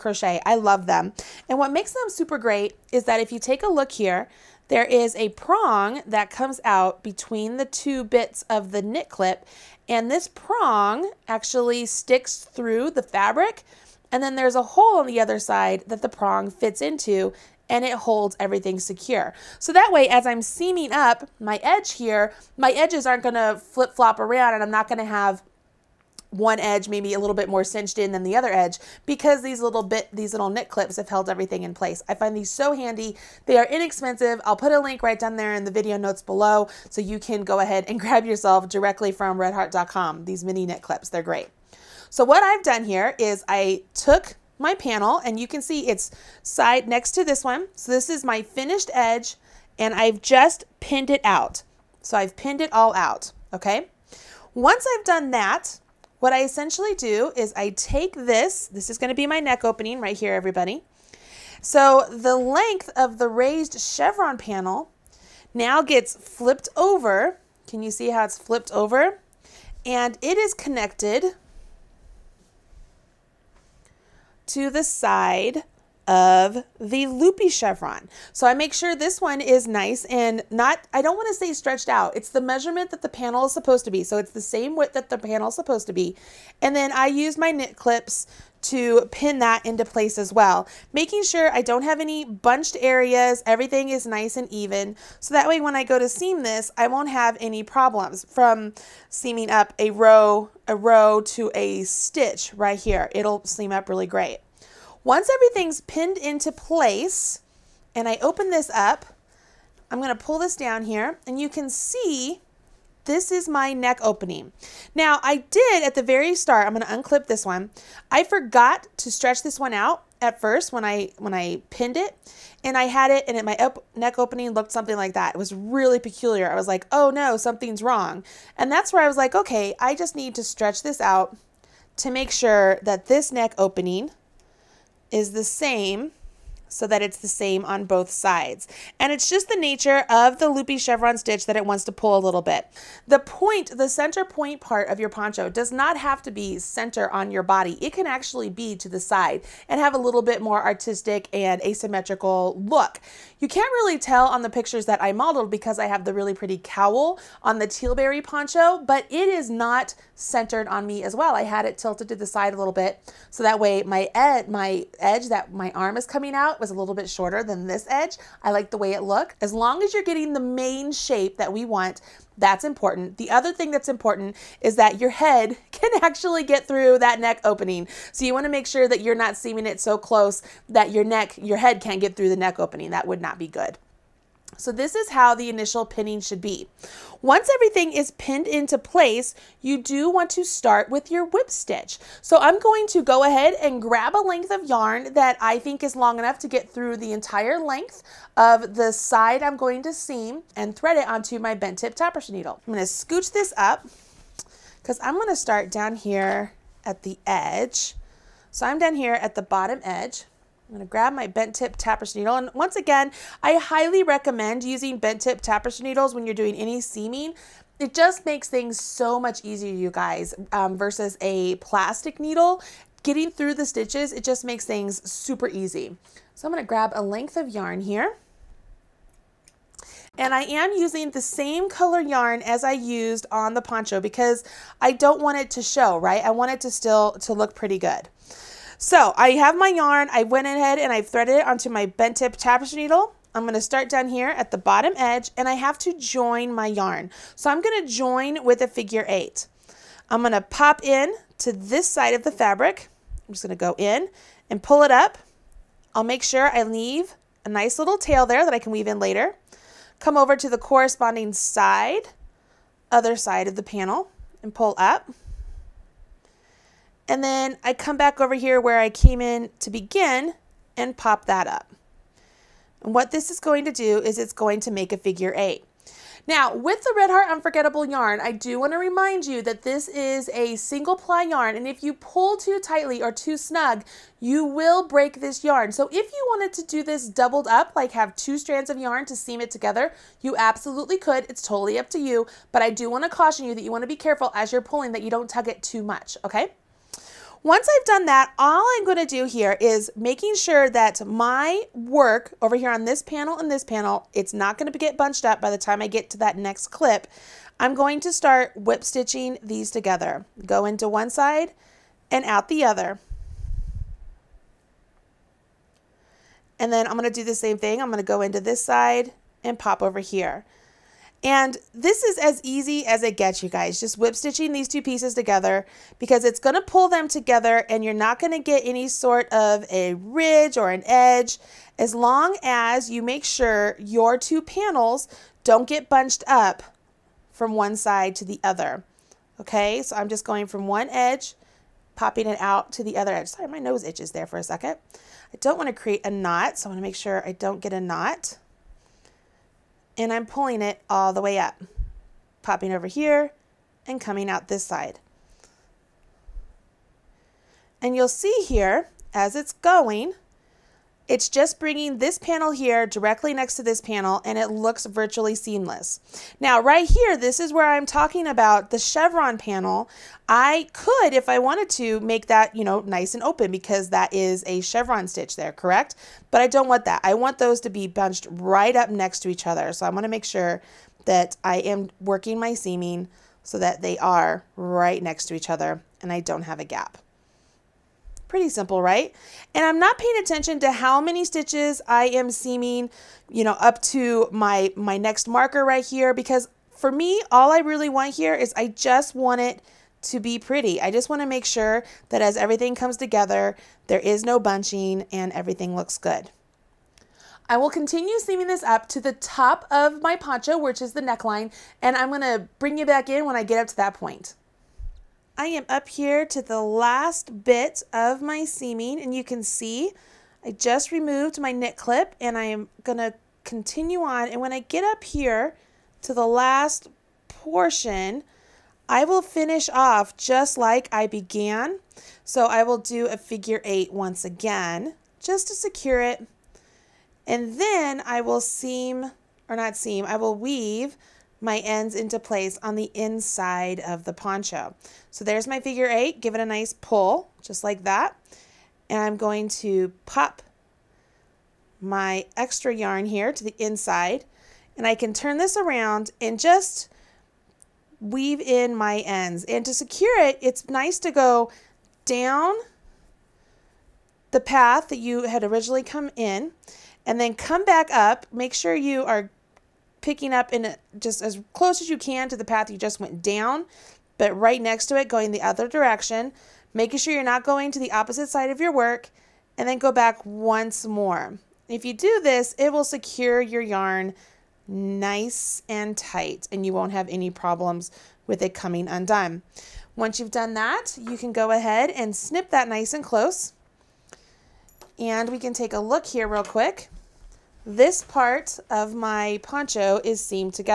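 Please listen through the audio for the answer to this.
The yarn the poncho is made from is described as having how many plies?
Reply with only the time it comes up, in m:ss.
4:40.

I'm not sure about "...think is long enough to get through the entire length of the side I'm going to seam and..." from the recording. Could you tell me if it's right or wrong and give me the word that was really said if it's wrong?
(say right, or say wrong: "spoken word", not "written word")
right.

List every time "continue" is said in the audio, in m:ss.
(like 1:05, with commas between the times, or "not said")
6:47, 7:03.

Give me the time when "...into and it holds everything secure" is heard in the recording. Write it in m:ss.
0:16.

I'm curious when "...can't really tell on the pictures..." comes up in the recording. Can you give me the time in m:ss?
2:33.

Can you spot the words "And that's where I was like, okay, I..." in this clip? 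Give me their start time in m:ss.
2:08.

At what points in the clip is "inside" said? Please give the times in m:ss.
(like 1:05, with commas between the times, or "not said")
7:22, 7:33.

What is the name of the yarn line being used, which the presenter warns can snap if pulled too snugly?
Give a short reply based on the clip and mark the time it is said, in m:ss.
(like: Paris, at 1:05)
Red Heart Unforgettable, at 4:36.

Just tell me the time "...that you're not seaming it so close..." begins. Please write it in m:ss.
2:58.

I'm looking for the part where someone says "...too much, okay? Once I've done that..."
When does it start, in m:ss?
4:55.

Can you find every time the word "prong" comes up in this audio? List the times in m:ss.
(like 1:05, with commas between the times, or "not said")
0:05, 0:10, 0:16.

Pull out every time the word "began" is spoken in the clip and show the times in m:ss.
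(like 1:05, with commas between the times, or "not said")
7:11.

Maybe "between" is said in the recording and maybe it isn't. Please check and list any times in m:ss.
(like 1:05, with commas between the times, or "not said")
0:07.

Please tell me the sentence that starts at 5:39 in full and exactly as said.
Okay, so I'm just going from one edge, popping it out to the other edge.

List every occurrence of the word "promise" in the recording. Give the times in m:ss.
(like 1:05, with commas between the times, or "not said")
not said.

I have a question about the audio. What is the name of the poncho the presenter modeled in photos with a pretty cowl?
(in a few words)
Tealberry poncho.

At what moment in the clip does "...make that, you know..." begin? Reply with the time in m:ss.
6:11.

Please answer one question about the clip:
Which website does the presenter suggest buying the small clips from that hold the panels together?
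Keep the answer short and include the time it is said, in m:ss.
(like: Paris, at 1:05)
redheart.com, at 0:39.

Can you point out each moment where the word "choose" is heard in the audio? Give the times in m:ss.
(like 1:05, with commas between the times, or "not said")
not said.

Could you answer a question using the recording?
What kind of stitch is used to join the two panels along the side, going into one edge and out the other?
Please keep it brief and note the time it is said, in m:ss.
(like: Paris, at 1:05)
Whip stitch, at 3:11.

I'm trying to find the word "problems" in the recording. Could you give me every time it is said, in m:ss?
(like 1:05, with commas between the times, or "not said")
1:37, 8:07.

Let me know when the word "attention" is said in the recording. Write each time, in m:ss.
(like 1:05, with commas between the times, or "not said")
6:30.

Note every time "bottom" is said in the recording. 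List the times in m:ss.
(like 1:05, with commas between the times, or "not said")
3:29, 4:04.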